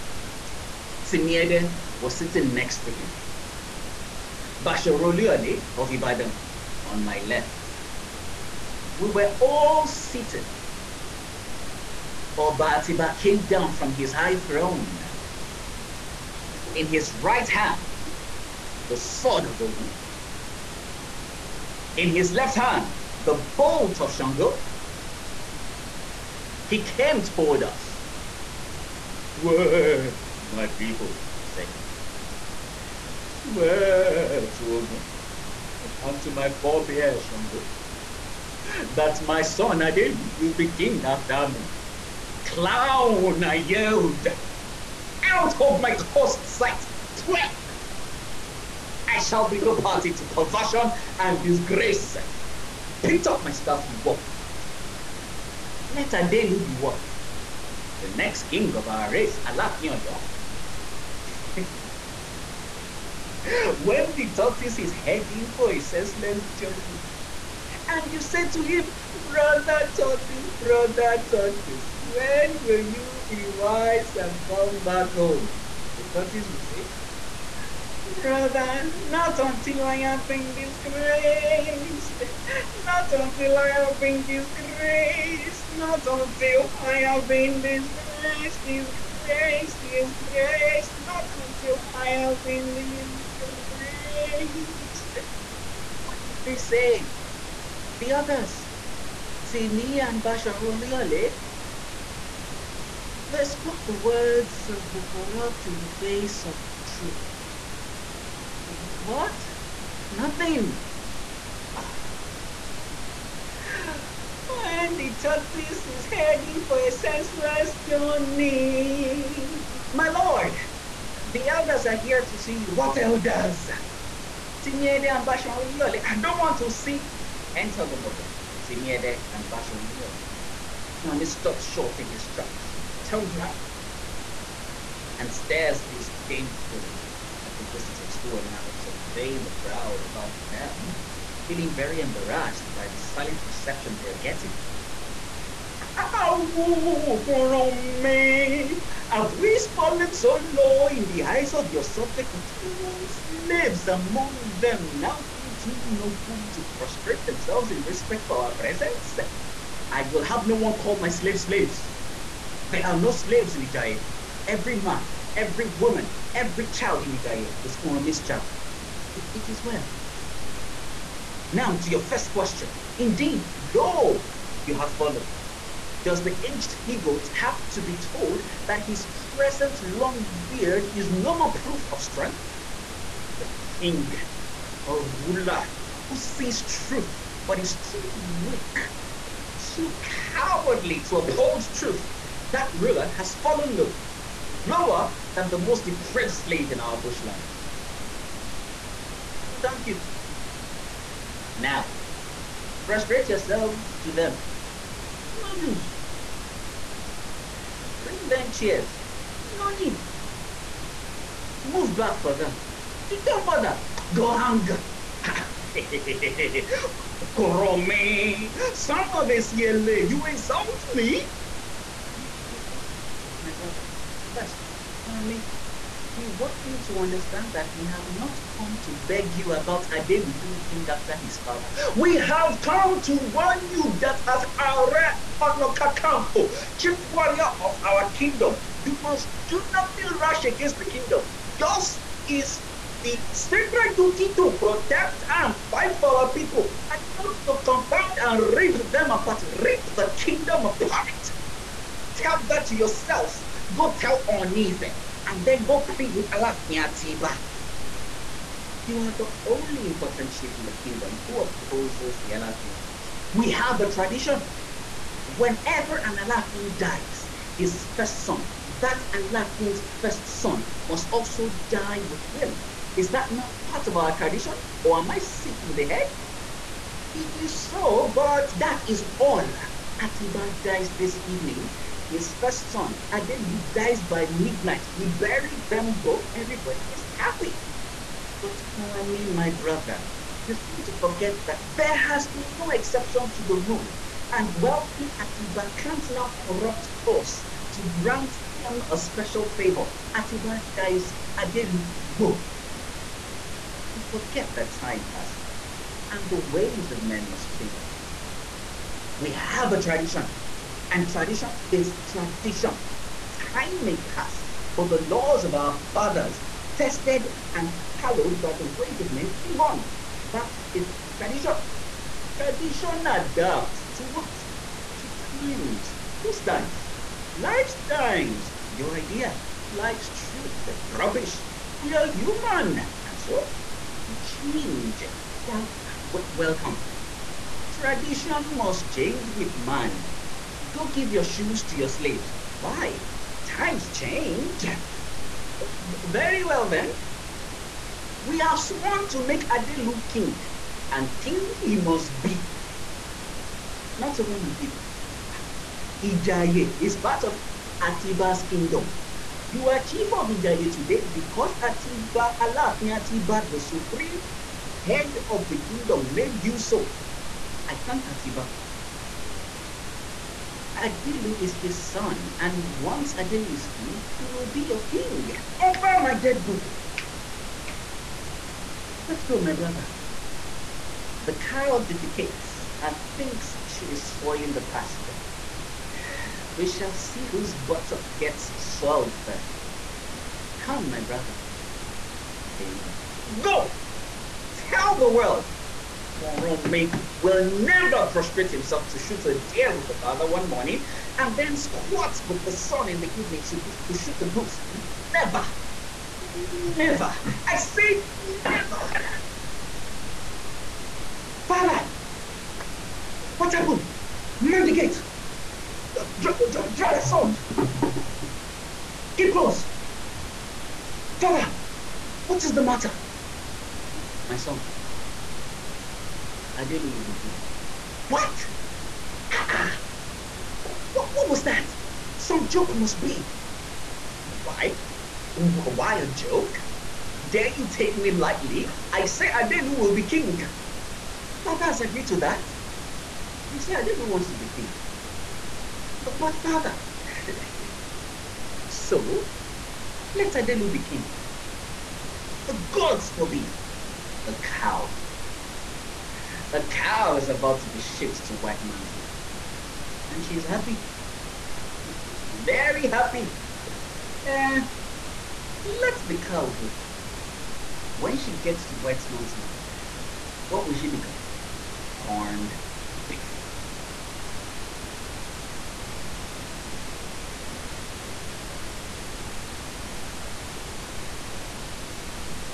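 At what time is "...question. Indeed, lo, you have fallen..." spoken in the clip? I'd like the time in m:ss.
2:52.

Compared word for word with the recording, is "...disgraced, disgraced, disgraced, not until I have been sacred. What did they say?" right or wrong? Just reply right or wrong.
wrong.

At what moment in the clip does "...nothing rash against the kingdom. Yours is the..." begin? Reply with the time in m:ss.
3:59.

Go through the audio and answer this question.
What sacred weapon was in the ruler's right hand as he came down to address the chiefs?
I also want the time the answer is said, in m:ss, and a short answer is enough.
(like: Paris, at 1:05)
the sword of Ogun, at 0:18.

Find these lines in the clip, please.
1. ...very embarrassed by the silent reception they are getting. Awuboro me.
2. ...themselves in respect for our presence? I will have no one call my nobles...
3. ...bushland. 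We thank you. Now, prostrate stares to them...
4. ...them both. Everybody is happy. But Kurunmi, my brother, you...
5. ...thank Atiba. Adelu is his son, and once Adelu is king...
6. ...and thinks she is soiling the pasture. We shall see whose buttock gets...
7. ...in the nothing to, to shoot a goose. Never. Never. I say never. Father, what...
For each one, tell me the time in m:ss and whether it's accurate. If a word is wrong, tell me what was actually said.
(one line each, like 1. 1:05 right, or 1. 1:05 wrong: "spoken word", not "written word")
1. 2:21 right
2. 2:37 wrong: "slaves", not "nobles"
3. 3:16 wrong: "yourselves", not "stares"
4. 4:45 right
5. 6:07 right
6. 6:22 right
7. 6:42 wrong: "evening", not "nothing".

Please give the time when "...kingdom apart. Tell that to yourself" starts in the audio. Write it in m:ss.
4:10.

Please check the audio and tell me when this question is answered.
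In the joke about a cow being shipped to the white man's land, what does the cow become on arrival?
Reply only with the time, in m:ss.
7:51.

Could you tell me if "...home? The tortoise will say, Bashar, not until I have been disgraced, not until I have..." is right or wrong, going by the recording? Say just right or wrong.
wrong.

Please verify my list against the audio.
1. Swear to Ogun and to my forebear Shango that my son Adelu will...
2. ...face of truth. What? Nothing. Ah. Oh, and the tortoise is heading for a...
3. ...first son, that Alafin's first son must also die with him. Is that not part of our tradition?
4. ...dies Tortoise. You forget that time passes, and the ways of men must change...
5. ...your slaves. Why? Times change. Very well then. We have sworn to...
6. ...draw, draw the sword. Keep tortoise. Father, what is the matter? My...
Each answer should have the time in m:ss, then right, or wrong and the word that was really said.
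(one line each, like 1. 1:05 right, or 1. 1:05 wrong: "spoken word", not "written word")
1. 0:33 right
2. 1:45 right
3. 4:27 right
4. 5:00 wrong: "Adelu", not "Tortoise"
5. 5:41 right
6. 6:56 wrong: "close", not "tortoise".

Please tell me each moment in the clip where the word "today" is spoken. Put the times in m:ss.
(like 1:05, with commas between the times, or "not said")
6:00.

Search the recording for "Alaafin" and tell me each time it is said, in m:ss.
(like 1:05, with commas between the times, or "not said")
6:02.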